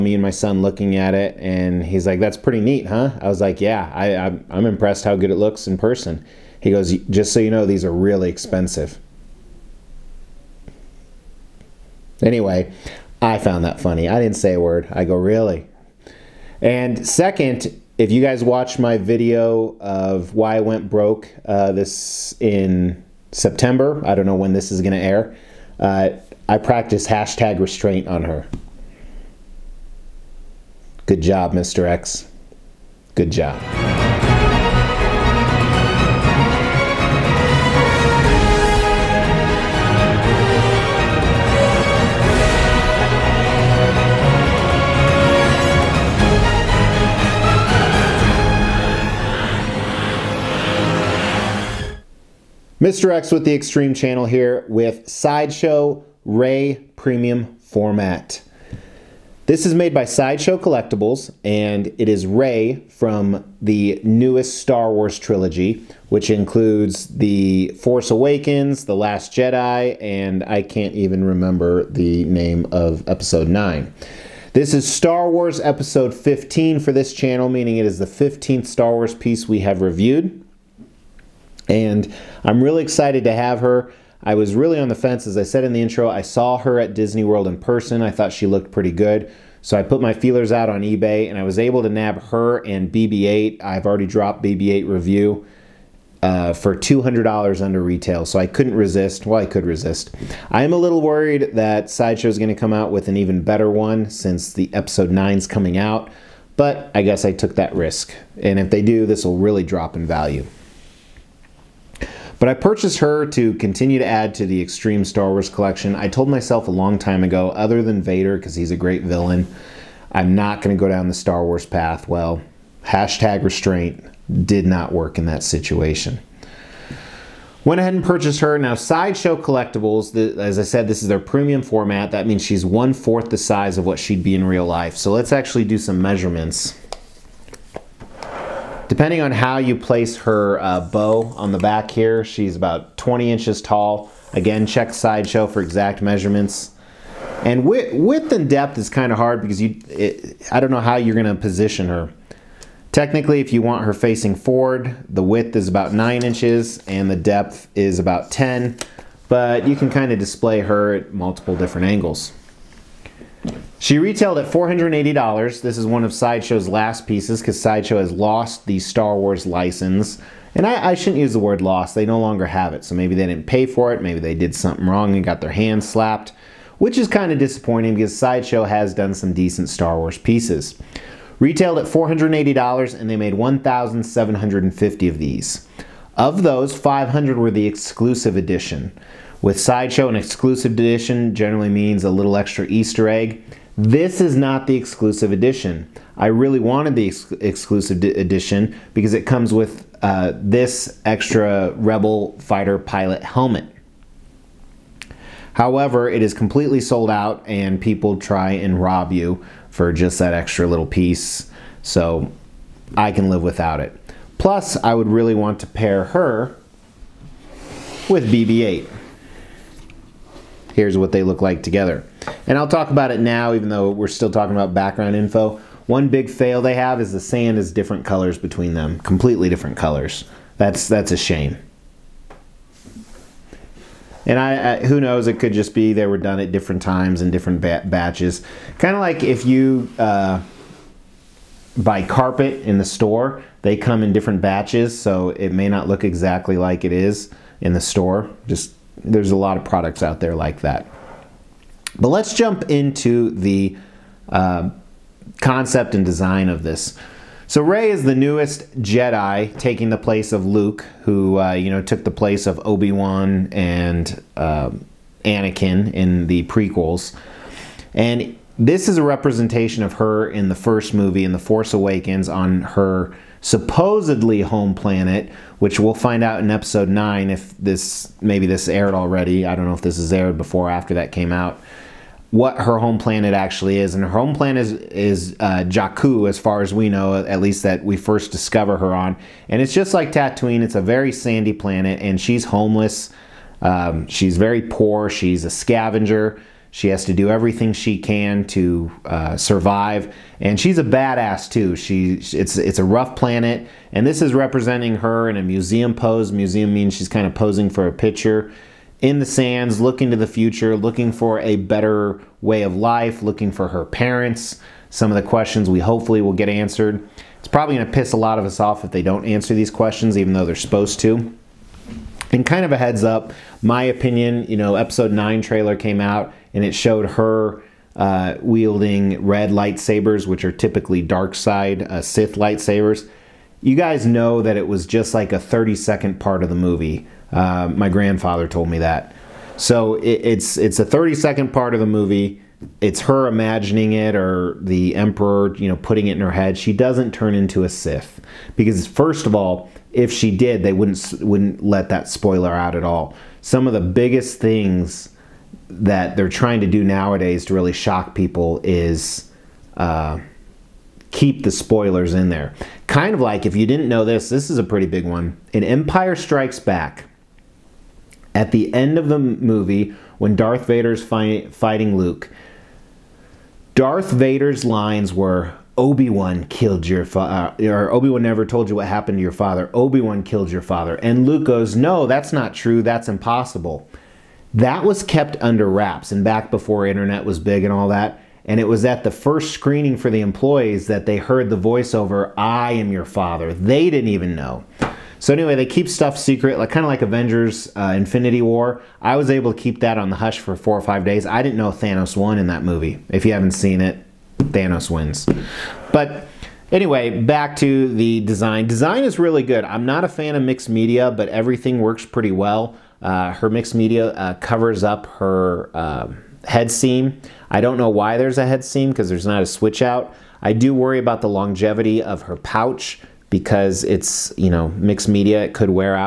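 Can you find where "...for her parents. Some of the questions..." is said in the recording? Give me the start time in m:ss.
5:13.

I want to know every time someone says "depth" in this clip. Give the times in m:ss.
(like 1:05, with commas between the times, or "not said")
2:28, 2:37.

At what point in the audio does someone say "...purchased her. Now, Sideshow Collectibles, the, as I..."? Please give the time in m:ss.
2:08.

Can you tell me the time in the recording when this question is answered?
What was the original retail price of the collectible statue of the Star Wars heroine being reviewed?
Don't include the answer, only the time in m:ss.
2:43.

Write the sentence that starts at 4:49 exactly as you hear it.
And it's just like Tatooine; it's a very sandy planet, and she's homeless.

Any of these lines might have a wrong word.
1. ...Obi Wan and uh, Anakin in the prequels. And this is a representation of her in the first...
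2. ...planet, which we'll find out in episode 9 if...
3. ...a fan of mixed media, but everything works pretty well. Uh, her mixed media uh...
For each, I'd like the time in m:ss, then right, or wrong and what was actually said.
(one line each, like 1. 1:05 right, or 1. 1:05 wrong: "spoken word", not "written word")
1. 4:22 right
2. 4:34 right
3. 6:50 right.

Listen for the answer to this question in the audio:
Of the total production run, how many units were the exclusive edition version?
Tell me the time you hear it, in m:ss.
3:06.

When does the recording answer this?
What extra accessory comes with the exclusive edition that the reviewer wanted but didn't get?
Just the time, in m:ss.
3:21.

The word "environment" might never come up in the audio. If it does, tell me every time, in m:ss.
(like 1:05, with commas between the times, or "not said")
not said.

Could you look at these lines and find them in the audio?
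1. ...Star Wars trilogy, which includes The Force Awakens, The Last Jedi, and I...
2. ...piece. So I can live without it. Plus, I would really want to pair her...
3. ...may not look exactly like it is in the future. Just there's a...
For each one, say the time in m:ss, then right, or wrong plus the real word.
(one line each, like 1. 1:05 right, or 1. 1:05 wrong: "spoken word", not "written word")
1. 1:04 right
2. 3:30 right
3. 4:05 wrong: "store", not "future".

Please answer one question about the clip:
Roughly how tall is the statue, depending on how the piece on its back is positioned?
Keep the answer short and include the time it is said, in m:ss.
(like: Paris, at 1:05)
20 inches, at 2:22.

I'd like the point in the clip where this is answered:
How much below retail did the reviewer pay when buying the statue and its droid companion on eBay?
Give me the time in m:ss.
1:36.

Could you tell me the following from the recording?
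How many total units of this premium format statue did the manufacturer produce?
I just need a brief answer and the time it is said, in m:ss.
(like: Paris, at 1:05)
1,750, at 3:03.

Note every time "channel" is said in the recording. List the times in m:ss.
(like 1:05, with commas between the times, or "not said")
0:53, 1:17.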